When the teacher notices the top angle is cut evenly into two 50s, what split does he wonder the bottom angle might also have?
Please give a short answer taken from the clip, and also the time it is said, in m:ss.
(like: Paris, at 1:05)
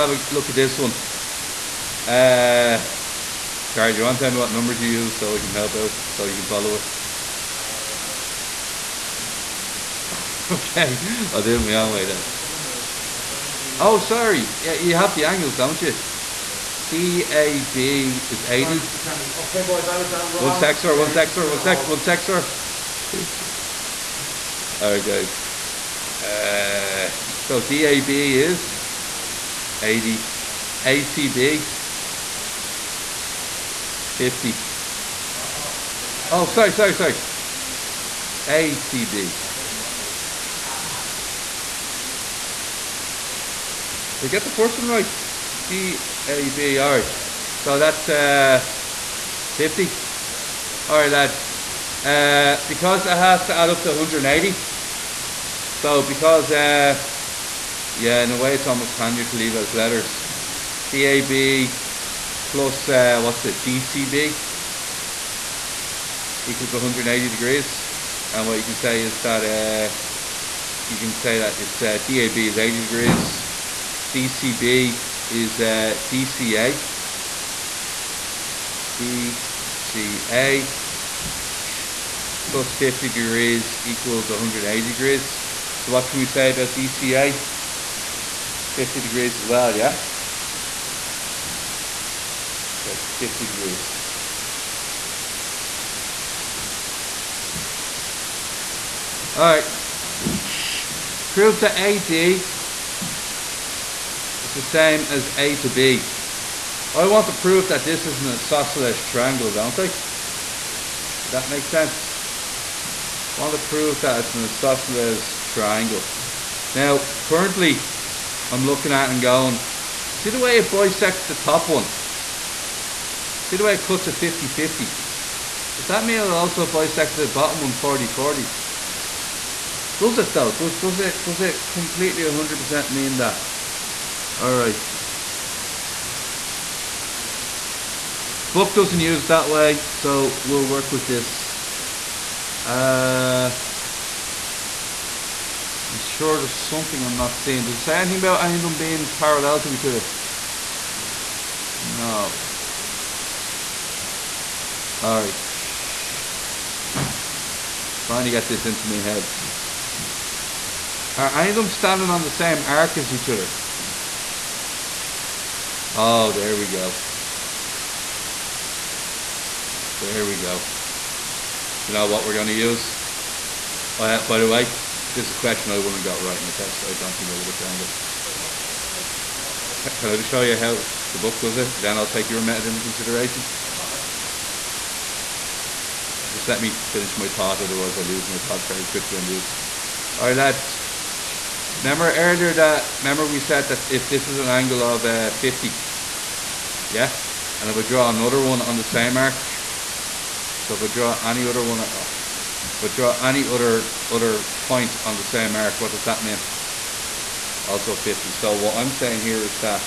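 40 40, at 2:07.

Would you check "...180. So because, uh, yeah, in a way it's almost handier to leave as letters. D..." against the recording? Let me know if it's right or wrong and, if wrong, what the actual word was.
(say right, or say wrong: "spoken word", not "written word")
right.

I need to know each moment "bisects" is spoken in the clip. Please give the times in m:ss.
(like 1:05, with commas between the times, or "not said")
2:00, 2:06.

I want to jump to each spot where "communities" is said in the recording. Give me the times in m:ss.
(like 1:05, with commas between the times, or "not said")
not said.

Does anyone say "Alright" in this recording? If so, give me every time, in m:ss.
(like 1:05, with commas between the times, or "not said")
0:24, 0:50, 2:14.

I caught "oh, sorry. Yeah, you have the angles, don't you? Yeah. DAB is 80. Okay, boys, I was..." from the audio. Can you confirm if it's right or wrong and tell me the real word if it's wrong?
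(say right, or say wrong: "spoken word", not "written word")
right.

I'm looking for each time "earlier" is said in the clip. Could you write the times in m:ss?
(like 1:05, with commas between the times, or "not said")
3:12.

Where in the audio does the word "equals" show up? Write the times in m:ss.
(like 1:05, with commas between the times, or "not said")
1:06, 1:23.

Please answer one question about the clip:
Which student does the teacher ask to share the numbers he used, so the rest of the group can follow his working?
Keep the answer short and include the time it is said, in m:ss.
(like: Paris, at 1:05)
Charlie, at 0:03.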